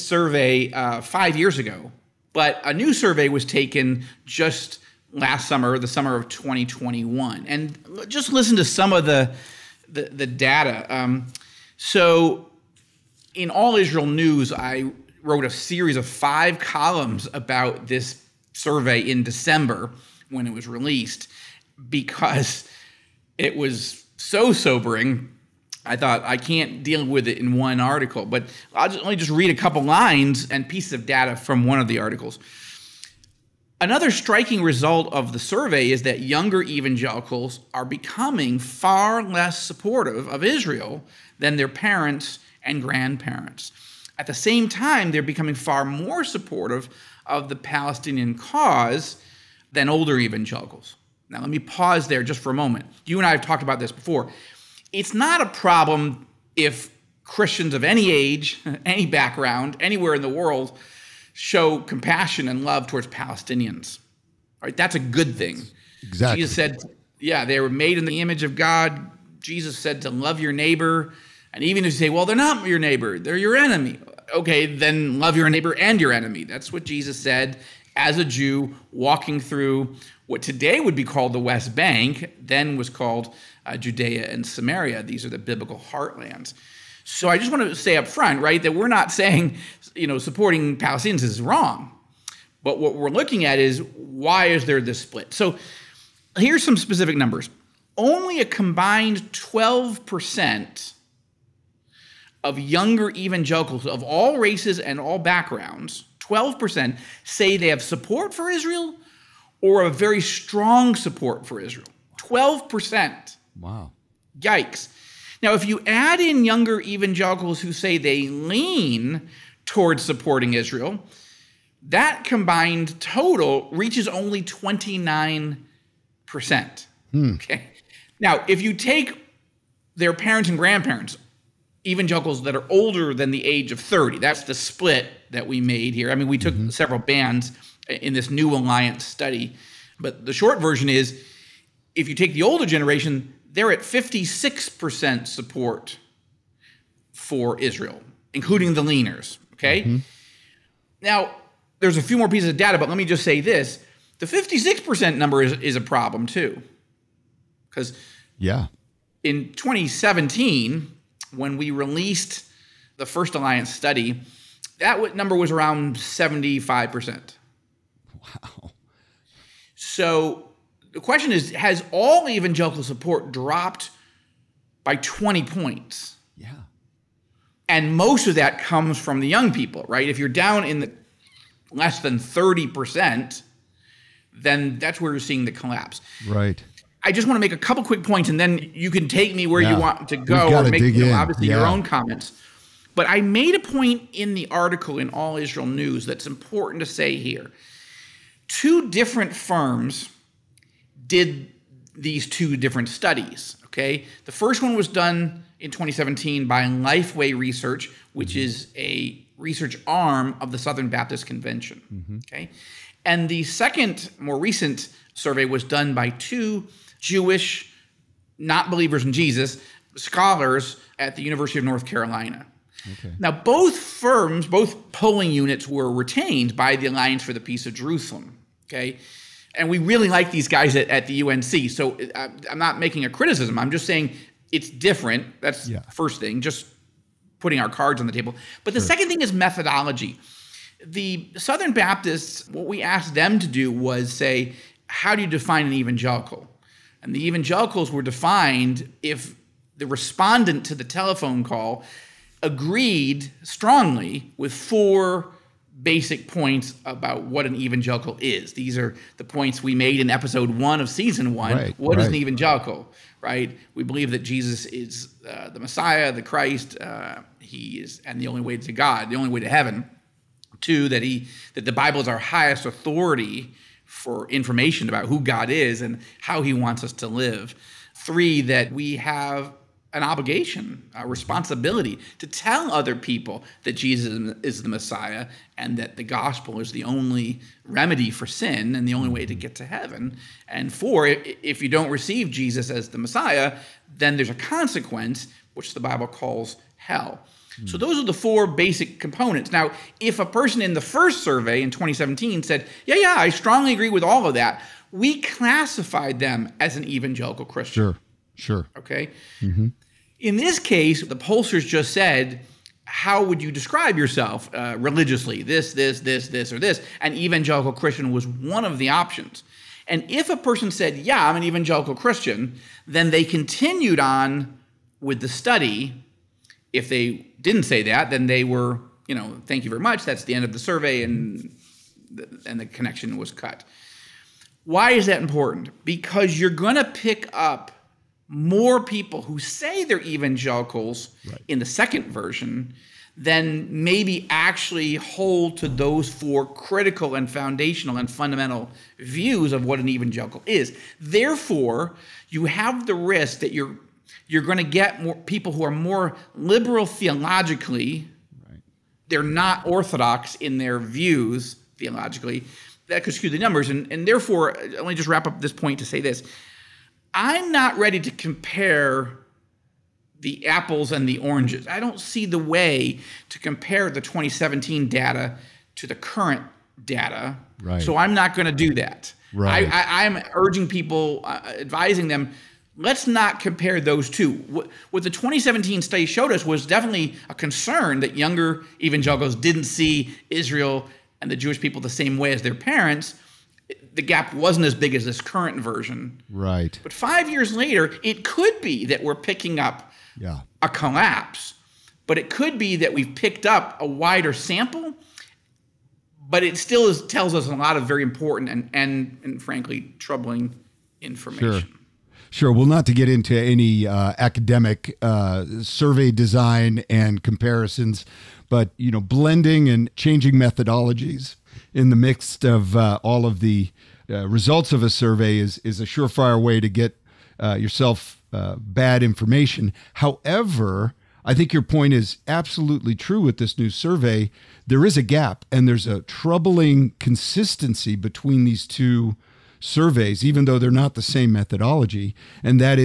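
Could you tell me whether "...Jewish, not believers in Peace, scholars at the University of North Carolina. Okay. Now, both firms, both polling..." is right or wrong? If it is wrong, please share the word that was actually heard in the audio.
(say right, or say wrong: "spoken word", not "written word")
wrong: "Jesus", not "Peace".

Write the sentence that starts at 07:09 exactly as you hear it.
However, I think your point is absolutely true with this new survey.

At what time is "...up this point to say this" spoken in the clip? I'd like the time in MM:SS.
06:05.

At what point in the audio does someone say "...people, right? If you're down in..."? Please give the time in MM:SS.
02:59.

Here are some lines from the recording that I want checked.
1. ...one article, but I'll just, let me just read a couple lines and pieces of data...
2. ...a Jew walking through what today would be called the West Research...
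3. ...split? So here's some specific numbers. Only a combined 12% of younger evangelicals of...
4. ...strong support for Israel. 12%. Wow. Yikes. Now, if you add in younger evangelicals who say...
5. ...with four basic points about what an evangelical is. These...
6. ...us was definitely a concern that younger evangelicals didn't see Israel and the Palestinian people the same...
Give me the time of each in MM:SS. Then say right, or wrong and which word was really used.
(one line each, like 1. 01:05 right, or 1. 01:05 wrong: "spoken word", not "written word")
1. 00:27 right
2. 01:18 wrong: "Bank", not "Research"
3. 01:34 right
4. 01:50 right
5. 04:14 right
6. 06:26 wrong: "Jewish", not "Palestinian".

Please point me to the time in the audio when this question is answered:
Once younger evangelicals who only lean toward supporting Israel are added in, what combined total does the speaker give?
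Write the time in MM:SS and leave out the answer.
02:04.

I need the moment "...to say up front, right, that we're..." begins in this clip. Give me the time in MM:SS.
01:27.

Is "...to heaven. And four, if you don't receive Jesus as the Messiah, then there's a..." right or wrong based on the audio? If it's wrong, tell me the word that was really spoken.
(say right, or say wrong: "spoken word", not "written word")
right.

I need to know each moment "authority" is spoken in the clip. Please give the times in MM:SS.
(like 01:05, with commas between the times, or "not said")
04:32.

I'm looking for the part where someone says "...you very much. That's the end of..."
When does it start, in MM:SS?
05:29.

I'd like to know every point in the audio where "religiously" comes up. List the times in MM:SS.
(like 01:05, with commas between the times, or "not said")
05:14.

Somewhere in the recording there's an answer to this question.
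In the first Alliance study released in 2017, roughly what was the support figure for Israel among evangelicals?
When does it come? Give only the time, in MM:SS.
02:45.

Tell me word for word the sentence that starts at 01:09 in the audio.
Jesus said to love your neighbor.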